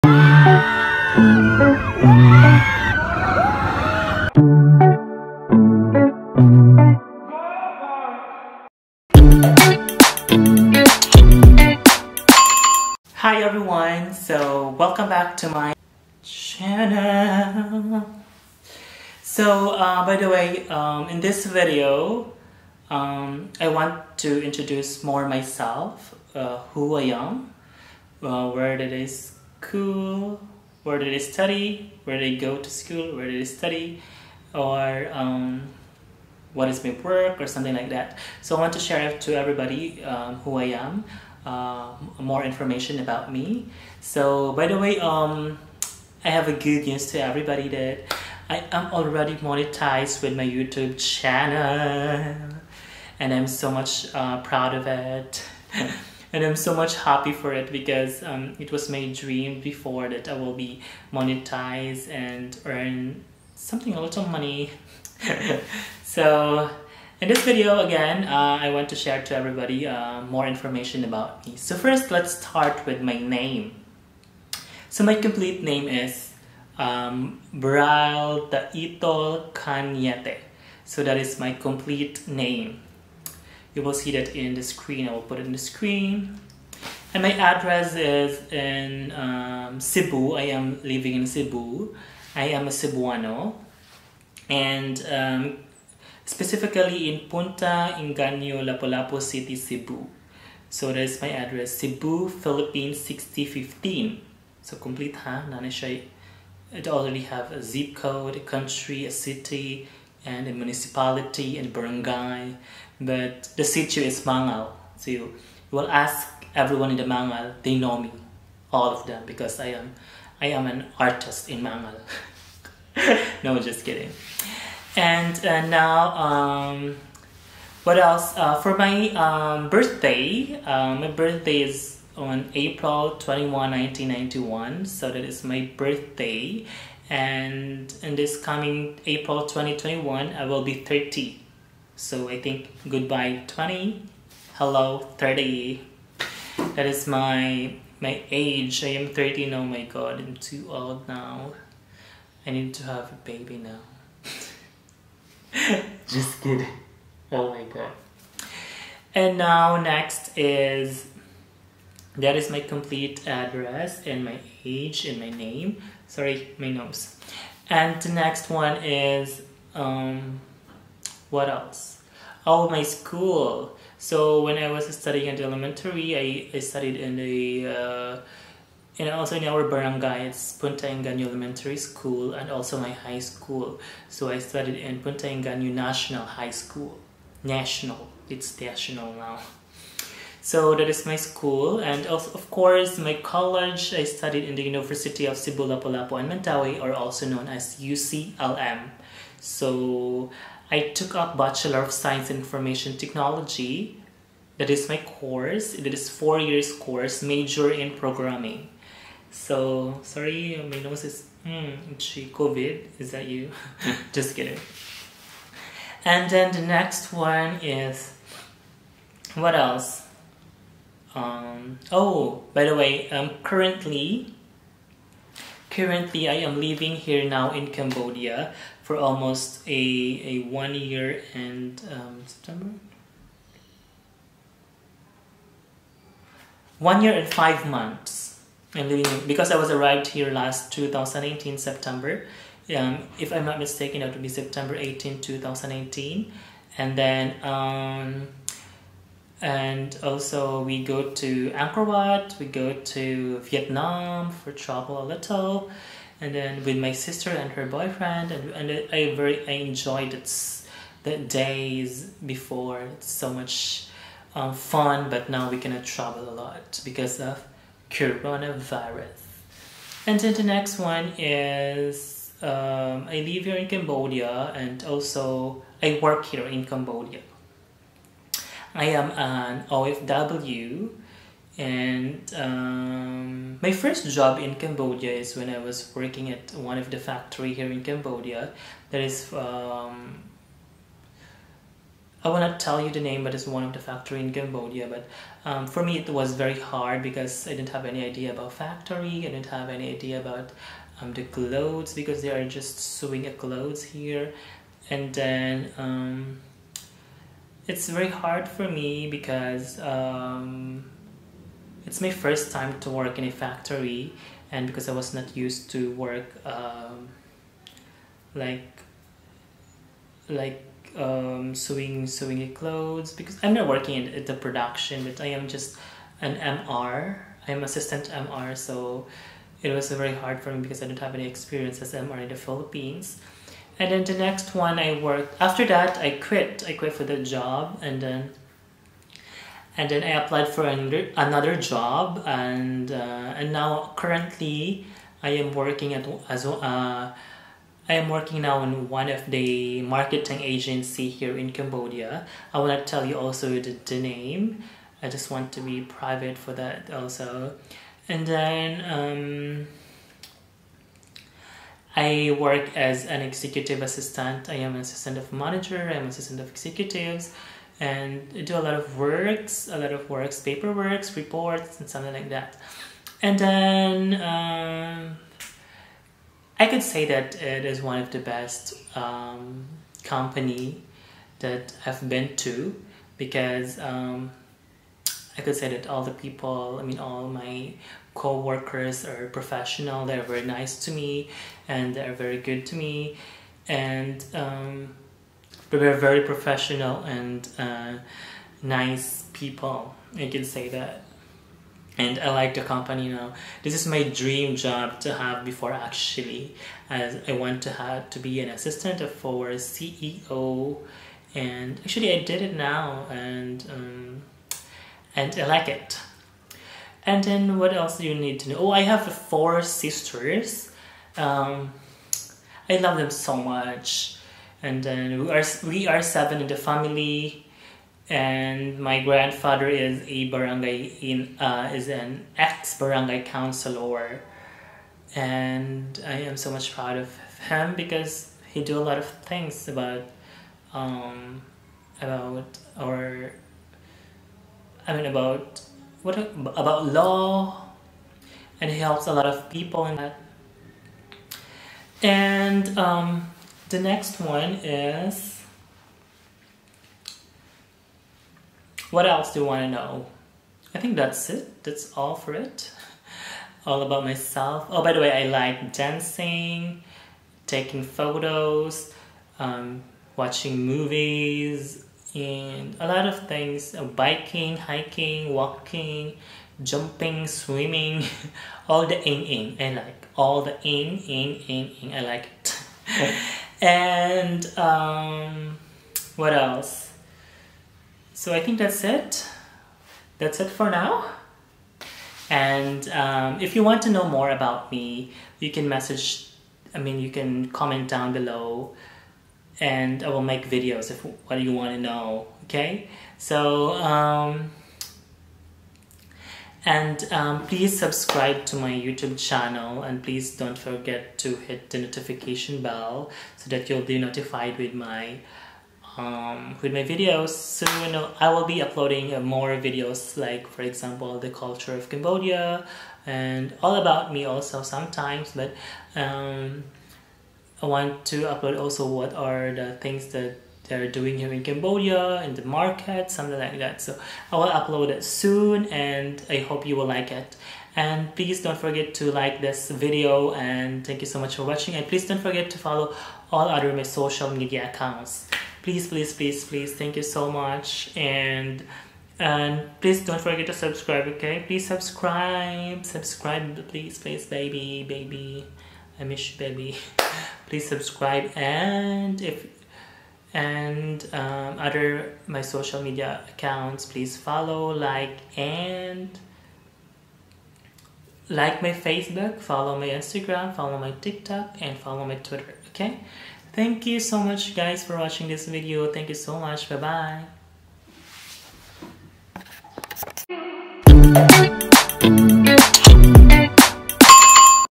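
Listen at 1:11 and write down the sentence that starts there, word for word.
So first, let's start with my name.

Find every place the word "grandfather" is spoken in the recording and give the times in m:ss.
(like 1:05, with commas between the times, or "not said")
7:09.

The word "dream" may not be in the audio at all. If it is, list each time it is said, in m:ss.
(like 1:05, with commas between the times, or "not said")
0:59, 6:44.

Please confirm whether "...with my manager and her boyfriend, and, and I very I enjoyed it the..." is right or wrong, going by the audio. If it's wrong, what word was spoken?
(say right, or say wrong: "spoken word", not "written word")
wrong: "sister", not "manager".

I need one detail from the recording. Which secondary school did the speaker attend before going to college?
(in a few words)
Punta Engano National High School.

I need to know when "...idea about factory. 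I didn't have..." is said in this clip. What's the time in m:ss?
4:58.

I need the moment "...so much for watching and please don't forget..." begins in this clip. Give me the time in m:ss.
9:01.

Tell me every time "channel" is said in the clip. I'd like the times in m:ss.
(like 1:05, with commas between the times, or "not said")
0:16, 0:50, 8:29.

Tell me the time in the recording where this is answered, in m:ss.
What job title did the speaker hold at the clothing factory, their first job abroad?
5:27.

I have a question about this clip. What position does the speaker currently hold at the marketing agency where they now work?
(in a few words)
Executive assistant.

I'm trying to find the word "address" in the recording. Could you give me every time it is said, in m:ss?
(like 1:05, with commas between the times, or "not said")
1:27, 1:41, 2:43.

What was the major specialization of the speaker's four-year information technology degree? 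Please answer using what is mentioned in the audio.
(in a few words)
Programming.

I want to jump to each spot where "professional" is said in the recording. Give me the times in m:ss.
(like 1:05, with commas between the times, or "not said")
6:29, 6:36.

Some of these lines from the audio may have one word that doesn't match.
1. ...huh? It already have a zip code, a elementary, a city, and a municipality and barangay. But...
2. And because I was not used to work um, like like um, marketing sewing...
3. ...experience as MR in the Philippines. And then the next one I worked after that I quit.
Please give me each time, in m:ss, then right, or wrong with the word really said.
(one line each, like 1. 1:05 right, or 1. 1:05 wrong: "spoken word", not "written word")
1. 1:45 wrong: "country", not "elementary"
2. 5:14 wrong: "sewing", not "marketing"
3. 5:31 right.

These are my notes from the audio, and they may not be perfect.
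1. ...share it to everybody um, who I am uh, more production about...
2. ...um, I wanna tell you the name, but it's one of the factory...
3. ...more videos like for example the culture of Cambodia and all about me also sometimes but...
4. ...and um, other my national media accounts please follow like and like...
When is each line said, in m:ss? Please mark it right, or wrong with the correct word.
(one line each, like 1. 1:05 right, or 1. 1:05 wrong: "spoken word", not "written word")
1. 0:38 wrong: "information", not "production"
2. 4:49 right
3. 8:39 right
4. 9:20 wrong: "social", not "national".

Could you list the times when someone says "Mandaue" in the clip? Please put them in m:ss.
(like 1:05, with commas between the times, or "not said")
3:16.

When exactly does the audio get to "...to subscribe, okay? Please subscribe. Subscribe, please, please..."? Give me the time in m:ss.
9:10.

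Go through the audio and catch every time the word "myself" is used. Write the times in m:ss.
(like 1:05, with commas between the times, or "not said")
0:25, 7:44.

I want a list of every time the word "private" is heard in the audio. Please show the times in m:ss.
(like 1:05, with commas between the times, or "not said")
5:55.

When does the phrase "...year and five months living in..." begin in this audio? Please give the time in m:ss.
3:57.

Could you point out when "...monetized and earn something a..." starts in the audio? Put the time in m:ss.
1:01.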